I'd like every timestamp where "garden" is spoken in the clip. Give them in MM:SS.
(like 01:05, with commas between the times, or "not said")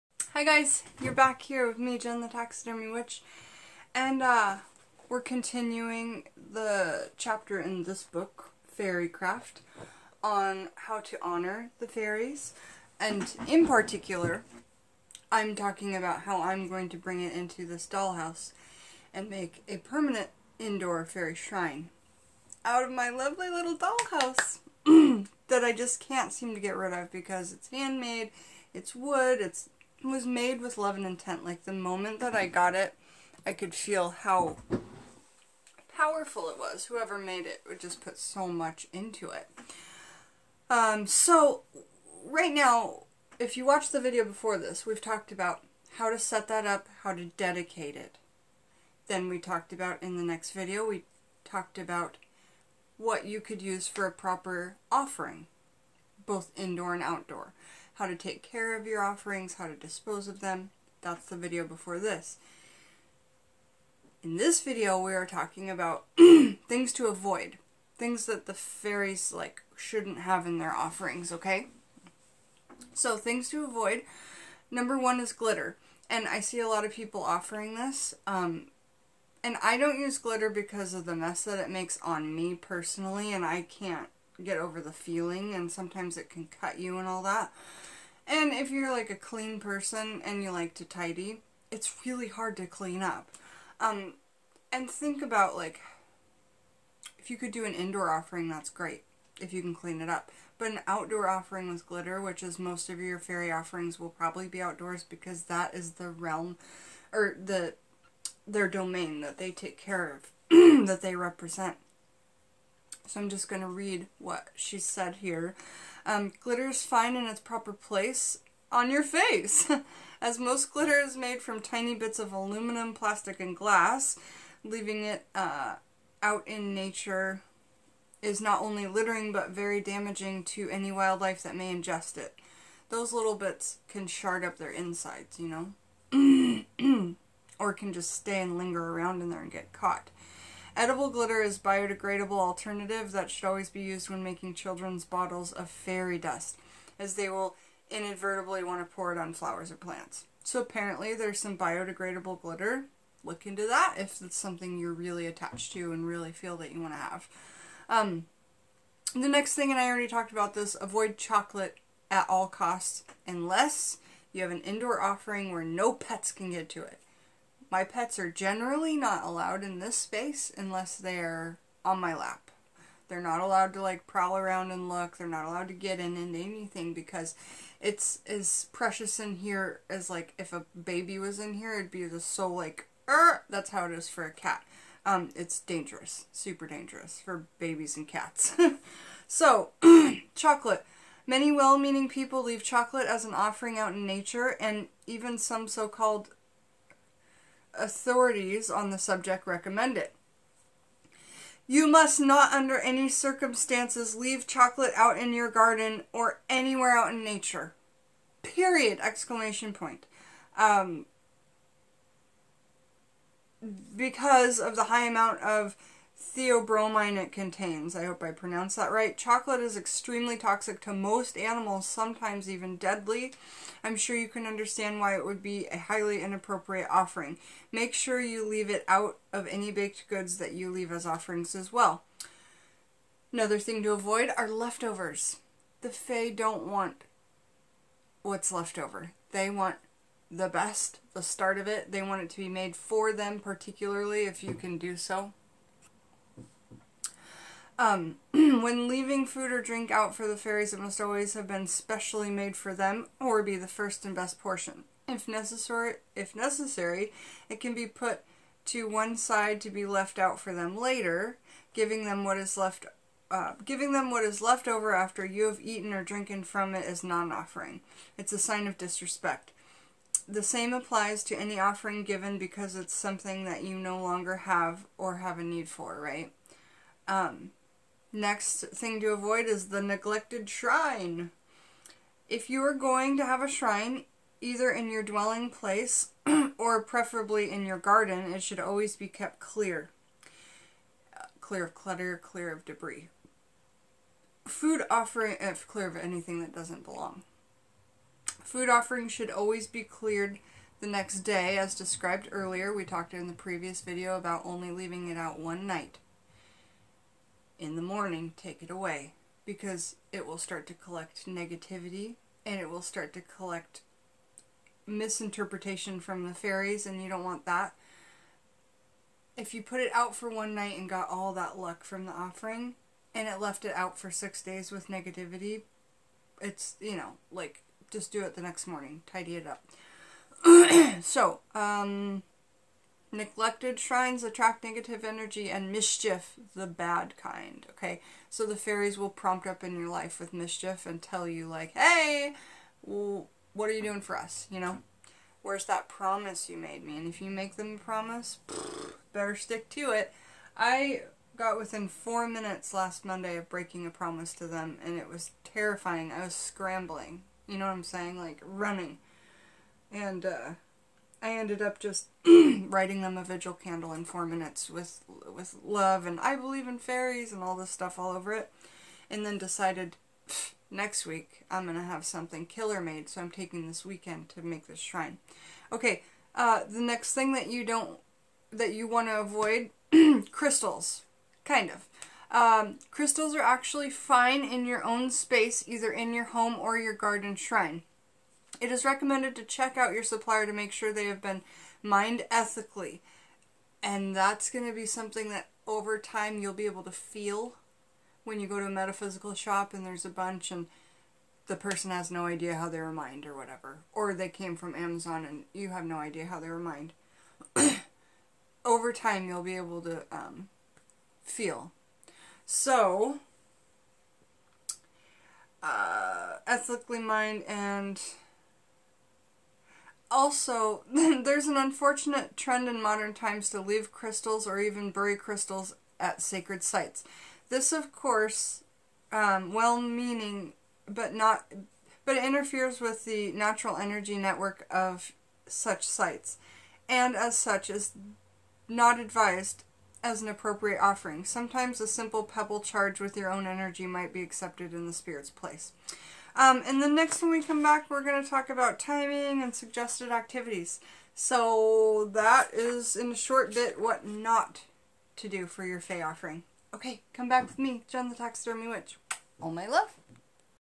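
03:25, 04:47, 06:26.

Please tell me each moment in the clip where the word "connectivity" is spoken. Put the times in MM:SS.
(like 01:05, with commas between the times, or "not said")
not said.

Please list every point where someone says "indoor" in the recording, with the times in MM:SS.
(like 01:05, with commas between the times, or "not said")
00:20, 00:56, 01:37, 02:44.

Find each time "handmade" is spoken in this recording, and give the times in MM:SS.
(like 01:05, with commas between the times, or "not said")
00:27.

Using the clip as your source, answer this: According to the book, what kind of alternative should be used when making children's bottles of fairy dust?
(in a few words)
Edible glitter.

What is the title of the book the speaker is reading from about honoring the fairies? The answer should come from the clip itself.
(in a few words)
Fairycraft.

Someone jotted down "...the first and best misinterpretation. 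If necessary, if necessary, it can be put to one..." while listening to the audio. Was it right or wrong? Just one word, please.
wrong.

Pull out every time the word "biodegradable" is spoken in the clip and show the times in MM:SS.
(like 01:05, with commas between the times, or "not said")
02:21, 02:31.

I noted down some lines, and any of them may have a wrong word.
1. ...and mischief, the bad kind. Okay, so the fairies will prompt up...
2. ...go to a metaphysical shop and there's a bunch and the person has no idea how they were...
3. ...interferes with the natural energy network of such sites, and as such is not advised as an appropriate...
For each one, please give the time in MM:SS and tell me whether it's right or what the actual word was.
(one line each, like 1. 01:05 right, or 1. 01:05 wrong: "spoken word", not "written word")
1. 05:35 right
2. 06:38 right
3. 07:12 right.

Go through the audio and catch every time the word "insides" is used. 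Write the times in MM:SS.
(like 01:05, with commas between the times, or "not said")
02:14.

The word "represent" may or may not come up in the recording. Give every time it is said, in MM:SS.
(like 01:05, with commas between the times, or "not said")
01:51.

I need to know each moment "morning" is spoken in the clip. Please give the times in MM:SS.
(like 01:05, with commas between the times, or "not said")
05:07, 05:28.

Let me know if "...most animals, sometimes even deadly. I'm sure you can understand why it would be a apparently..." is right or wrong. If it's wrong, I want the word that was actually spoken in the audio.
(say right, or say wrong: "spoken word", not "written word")
wrong: "highly", not "apparently".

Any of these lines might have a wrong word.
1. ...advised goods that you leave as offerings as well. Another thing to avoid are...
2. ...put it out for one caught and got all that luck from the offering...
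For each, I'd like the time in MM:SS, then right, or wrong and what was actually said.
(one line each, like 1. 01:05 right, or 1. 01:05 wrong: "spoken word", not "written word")
1. 03:49 wrong: "baked", not "advised"
2. 05:19 wrong: "night", not "caught".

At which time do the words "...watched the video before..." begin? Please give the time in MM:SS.
00:43.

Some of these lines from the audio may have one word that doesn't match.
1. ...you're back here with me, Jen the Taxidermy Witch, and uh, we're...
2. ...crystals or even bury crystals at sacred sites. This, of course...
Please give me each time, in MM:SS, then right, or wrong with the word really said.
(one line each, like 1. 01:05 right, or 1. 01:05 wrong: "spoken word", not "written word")
1. 00:01 right
2. 07:03 right.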